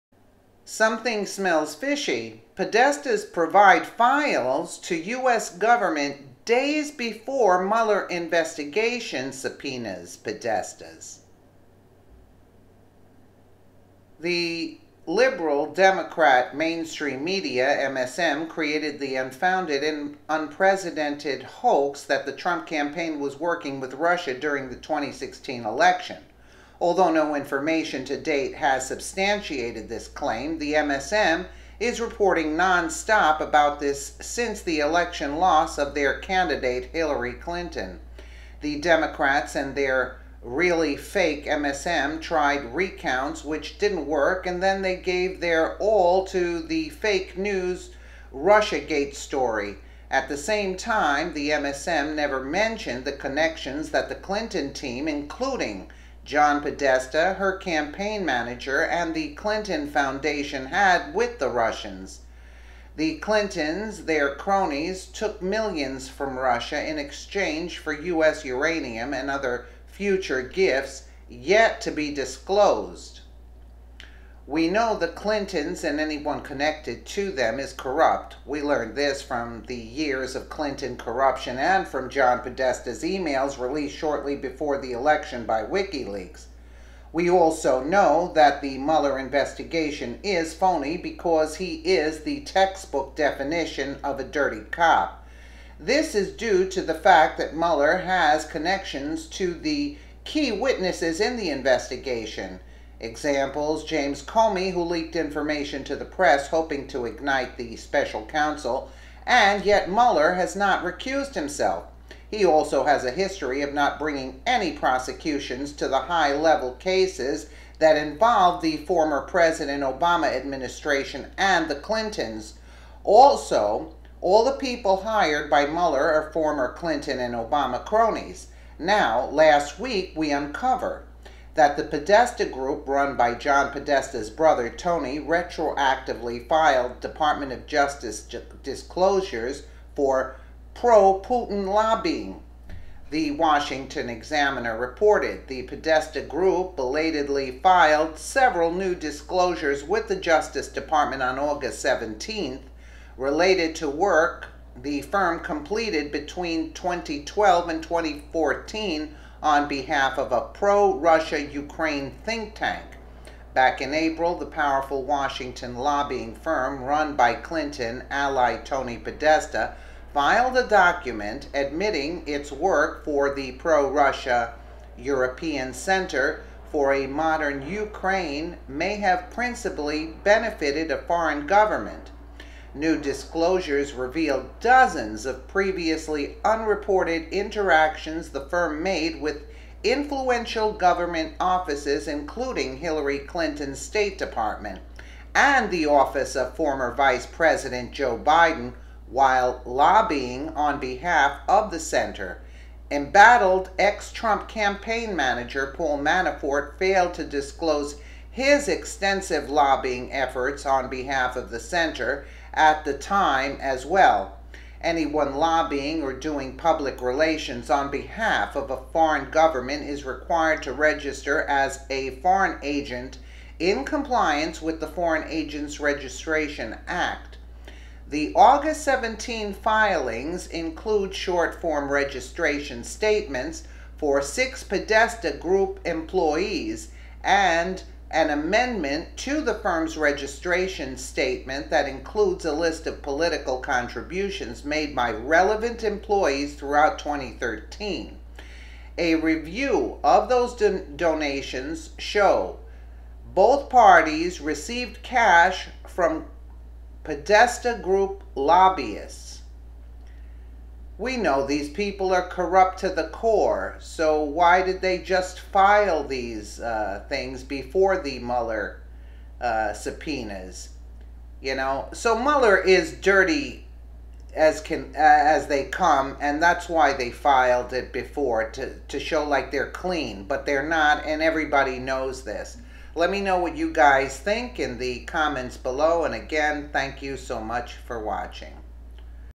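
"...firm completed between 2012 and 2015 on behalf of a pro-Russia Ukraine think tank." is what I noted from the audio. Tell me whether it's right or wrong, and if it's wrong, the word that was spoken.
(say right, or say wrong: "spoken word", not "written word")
wrong: "2014", not "2015".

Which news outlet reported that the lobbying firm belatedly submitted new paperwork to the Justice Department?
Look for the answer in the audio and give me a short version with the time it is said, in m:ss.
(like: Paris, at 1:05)
Washington Examiner, at 2:23.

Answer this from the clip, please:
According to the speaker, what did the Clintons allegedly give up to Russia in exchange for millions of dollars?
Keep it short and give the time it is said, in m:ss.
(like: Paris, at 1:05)
U.S. uranium, at 1:07.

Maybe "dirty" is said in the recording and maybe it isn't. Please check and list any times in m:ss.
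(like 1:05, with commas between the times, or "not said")
1:34, 4:32.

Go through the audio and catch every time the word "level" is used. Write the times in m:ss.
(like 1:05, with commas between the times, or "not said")
1:56.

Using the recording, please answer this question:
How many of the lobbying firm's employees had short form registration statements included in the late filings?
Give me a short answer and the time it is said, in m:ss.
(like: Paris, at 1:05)
6, at 3:54.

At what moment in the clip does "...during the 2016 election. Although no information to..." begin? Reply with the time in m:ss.
0:24.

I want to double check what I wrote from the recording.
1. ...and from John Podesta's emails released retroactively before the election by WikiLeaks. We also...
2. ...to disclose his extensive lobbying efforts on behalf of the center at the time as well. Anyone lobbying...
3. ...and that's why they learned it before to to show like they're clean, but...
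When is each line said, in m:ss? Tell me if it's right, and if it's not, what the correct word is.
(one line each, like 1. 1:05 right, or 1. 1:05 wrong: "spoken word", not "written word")
1. 1:21 wrong: "shortly", not "retroactively"
2. 3:27 right
3. 4:36 wrong: "filed", not "learned".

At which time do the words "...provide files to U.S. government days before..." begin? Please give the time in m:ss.
0:03.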